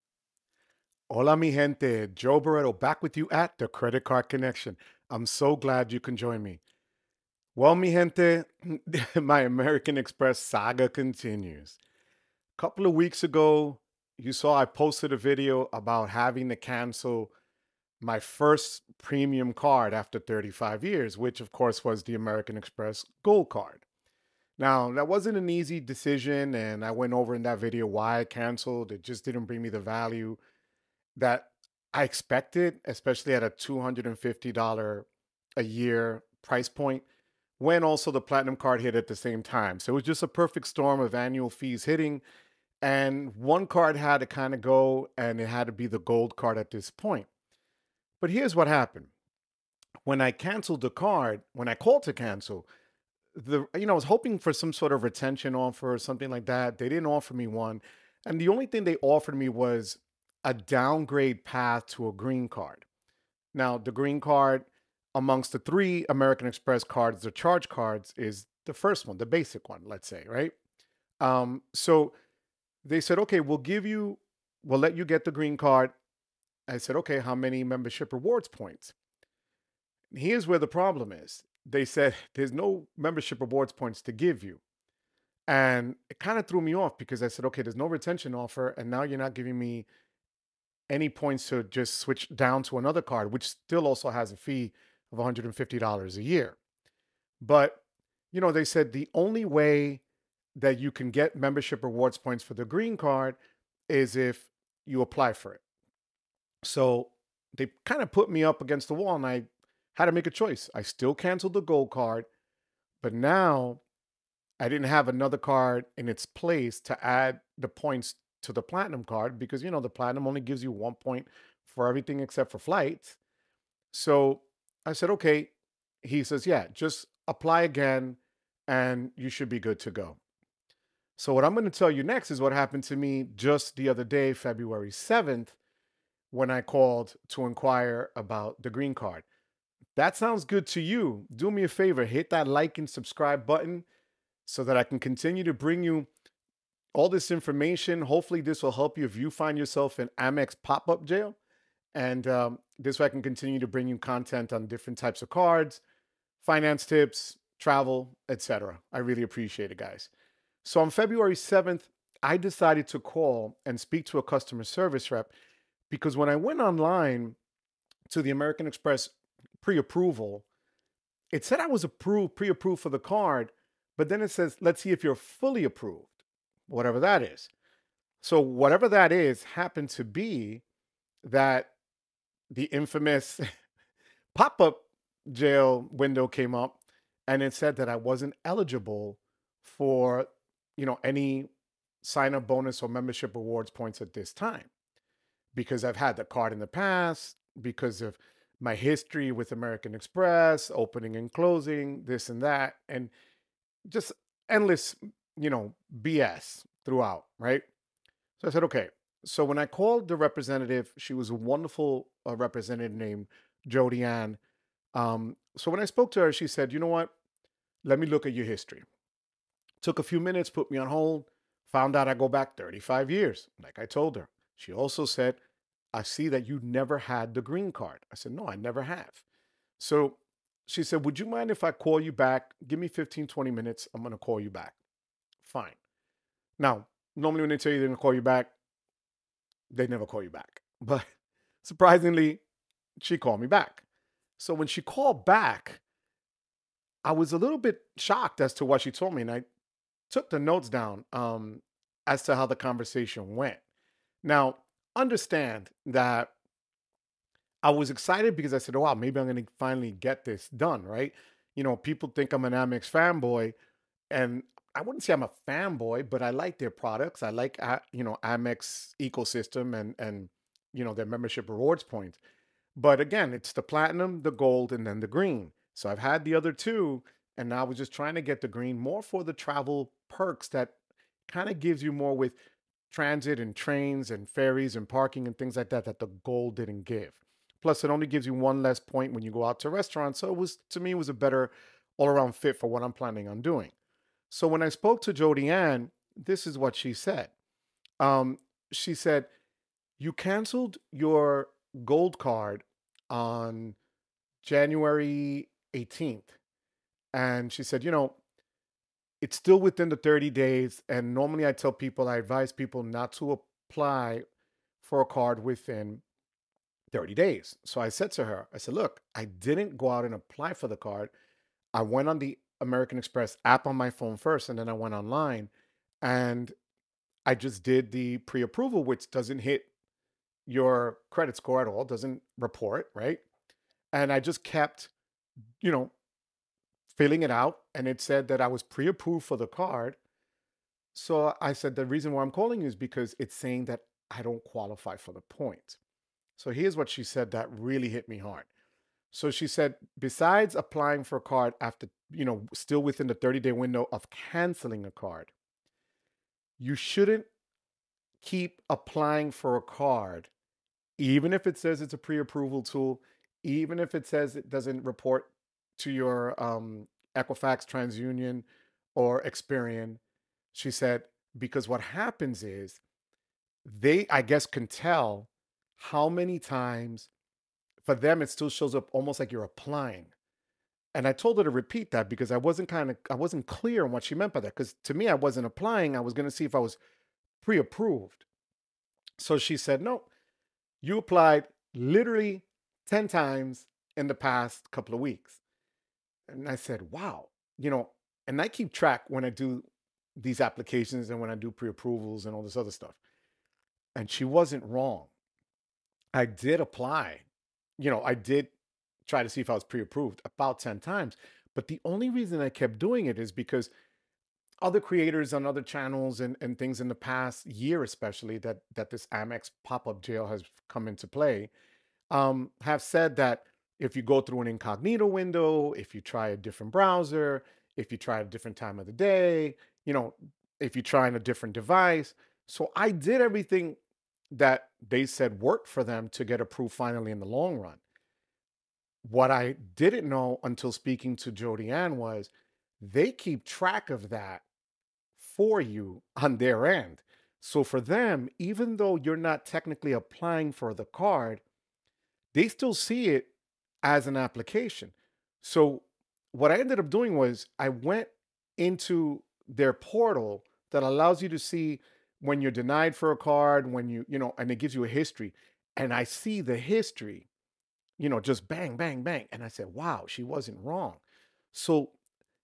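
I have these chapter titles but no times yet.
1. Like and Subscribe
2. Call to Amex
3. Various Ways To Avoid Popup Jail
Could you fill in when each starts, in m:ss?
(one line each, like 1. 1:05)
1. 2:20
2. 2:40
3. 6:59.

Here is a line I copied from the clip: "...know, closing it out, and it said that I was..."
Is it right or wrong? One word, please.
wrong.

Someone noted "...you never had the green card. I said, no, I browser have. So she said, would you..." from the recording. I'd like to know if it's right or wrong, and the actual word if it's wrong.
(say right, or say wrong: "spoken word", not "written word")
wrong: "never", not "browser".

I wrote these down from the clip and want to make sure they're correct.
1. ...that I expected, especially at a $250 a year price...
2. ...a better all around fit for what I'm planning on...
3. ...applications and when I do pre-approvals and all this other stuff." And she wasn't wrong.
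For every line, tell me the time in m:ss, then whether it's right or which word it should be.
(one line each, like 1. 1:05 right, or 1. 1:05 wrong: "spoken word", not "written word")
1. 0:31 right
2. 4:51 right
3. 6:40 right.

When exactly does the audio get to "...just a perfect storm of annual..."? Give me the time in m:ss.
0:40.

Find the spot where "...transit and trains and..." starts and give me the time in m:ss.
4:42.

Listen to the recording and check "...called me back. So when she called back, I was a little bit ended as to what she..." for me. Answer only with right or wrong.
wrong.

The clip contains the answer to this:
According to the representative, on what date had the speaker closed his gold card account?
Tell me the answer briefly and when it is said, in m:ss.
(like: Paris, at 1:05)
January 18th, at 5:04.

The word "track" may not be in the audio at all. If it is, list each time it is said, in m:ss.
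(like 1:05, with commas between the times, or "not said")
6:38, 7:23.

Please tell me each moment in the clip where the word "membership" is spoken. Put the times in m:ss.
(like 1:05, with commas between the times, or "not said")
1:17, 1:22, 1:41, 3:12, 4:31.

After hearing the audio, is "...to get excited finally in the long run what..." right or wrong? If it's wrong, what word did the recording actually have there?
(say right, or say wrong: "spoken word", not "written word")
wrong: "approved", not "excited".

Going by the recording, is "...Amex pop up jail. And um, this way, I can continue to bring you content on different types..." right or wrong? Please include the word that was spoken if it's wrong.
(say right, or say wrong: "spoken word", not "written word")
right.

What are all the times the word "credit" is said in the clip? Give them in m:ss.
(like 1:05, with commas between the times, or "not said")
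0:03, 5:31.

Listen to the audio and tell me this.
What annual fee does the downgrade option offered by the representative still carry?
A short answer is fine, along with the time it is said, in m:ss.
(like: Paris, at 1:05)
$150, at 1:35.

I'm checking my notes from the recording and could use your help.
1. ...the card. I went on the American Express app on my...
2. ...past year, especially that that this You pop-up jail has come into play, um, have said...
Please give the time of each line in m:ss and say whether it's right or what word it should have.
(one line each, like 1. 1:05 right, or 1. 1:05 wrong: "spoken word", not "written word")
1. 5:20 right
2. 6:56 wrong: "Amex", not "You".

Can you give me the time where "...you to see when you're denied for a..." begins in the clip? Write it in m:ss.
7:41.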